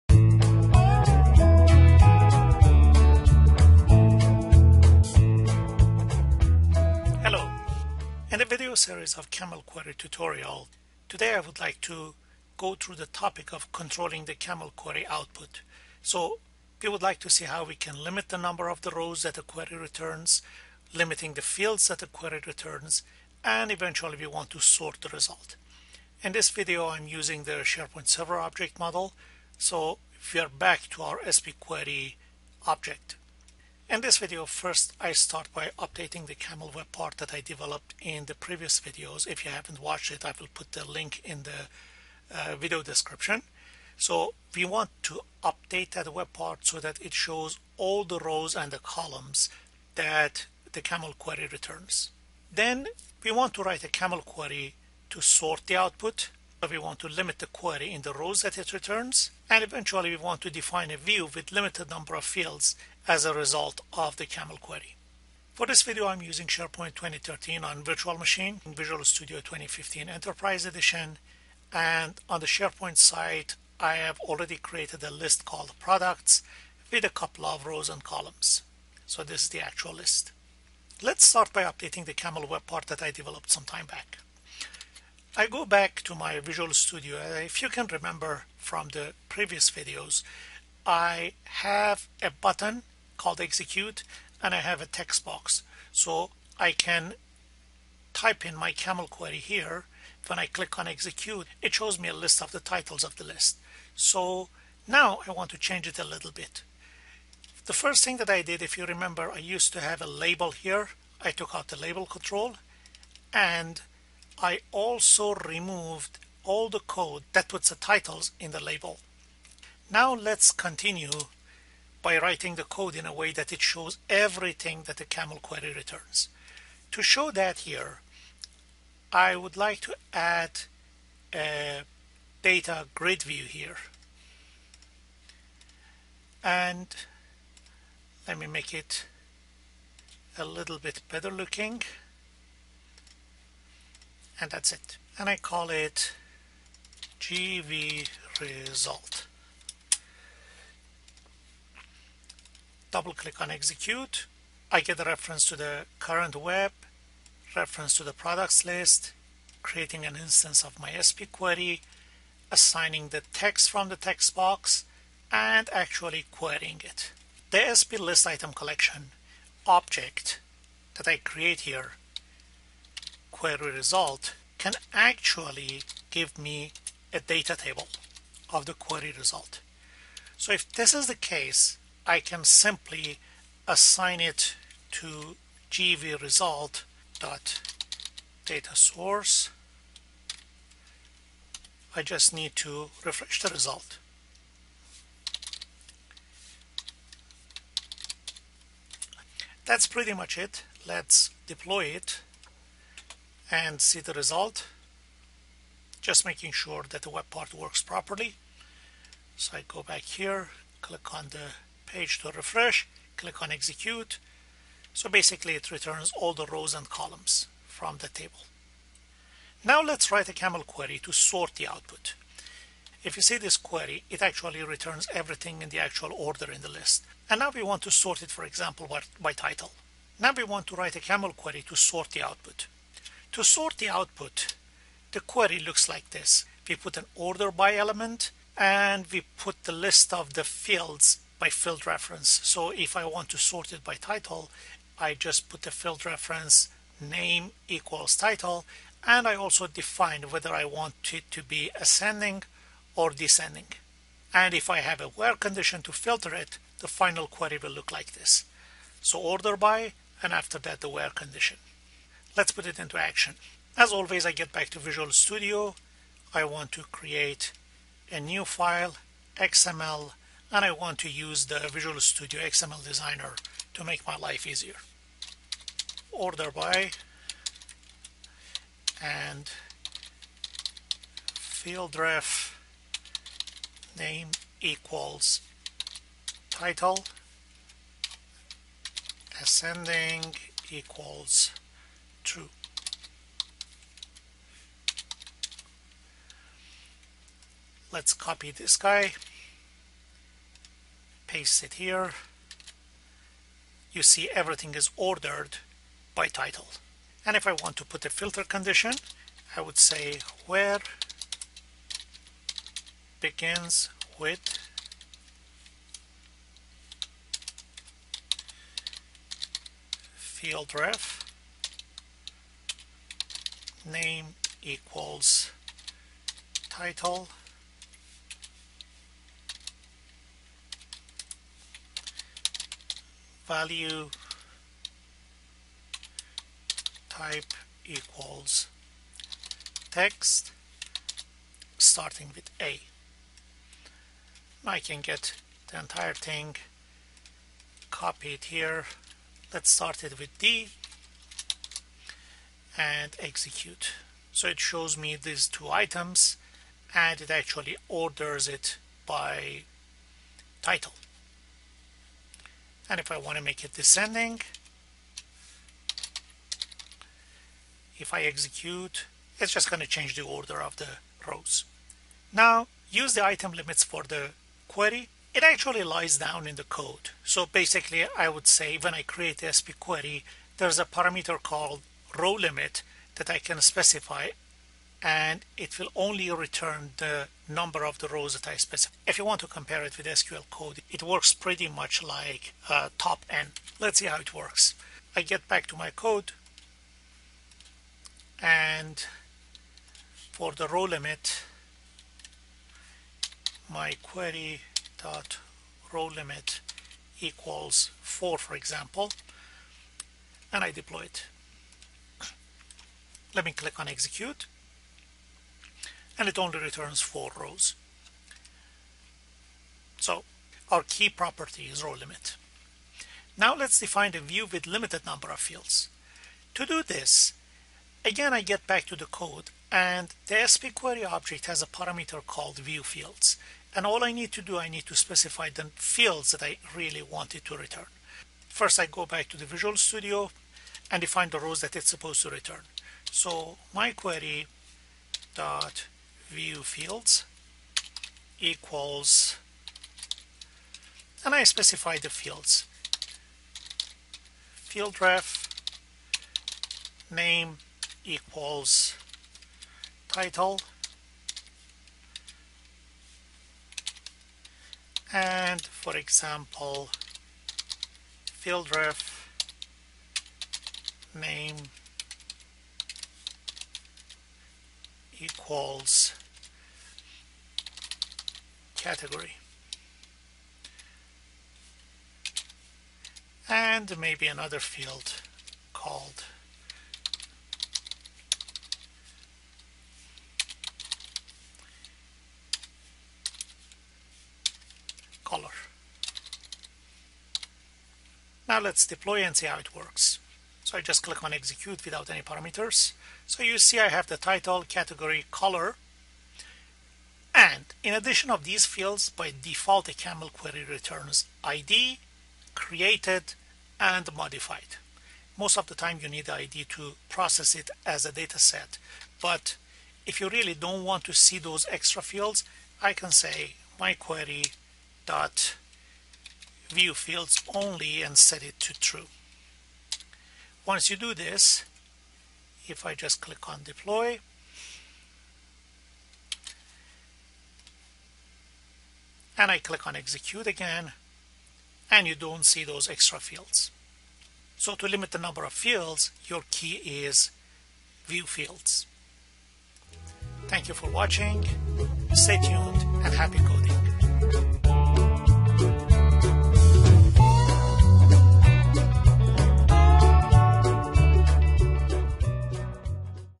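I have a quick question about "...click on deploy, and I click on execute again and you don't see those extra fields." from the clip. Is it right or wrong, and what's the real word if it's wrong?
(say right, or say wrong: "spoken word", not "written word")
right.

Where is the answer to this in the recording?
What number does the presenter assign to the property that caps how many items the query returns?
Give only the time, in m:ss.
6:48.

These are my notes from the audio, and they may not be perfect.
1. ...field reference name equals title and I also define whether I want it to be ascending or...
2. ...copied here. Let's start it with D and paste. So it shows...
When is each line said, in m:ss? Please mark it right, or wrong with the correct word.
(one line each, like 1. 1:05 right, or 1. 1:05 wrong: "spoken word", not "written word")
1. 4:05 right
2. 5:47 wrong: "execute", not "paste".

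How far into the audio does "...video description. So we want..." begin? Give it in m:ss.
0:42.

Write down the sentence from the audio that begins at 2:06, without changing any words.
To show that here, I would like to add a data grid view here.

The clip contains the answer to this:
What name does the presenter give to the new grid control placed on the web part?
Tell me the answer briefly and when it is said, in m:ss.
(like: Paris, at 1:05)
GV result, at 2:27.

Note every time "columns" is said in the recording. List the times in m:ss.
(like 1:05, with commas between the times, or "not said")
0:48, 1:18, 3:36.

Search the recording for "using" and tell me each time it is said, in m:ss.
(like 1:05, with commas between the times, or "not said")
0:27, 1:06.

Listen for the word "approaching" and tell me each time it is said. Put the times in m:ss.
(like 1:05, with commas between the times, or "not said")
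not said.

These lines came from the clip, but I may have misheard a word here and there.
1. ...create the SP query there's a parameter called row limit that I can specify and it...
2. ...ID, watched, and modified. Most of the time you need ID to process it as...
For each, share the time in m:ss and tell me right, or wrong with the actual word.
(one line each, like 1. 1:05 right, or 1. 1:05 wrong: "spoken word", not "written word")
1. 6:19 right
2. 8:31 wrong: "created", not "watched".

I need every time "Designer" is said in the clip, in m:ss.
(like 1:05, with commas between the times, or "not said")
4:32.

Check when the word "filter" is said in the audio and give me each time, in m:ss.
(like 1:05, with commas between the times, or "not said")
4:16, 5:08.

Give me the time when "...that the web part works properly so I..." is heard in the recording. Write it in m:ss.
3:26.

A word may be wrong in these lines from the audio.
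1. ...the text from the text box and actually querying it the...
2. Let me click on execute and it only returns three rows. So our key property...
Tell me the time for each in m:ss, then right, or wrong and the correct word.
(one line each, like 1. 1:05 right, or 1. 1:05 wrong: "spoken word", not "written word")
1. 2:43 right
2. 6:53 wrong: "four", not "three".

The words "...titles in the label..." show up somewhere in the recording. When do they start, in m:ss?
1:57.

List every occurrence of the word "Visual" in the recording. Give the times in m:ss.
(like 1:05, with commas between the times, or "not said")
1:08, 1:26, 4:24, 4:31, 7:19.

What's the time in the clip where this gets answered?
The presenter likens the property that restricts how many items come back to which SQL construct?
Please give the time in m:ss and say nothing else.
6:32.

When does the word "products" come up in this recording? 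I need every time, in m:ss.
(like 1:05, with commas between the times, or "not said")
1:15, 2:38.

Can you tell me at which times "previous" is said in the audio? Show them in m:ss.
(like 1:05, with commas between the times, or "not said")
0:38, 1:29.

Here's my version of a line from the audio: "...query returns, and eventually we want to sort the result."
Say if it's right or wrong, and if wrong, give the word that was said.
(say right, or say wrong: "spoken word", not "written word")
right.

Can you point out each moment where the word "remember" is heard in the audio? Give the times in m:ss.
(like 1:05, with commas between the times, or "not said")
1:27, 1:48.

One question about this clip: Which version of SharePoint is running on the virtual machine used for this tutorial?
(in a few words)
SharePoint 2013.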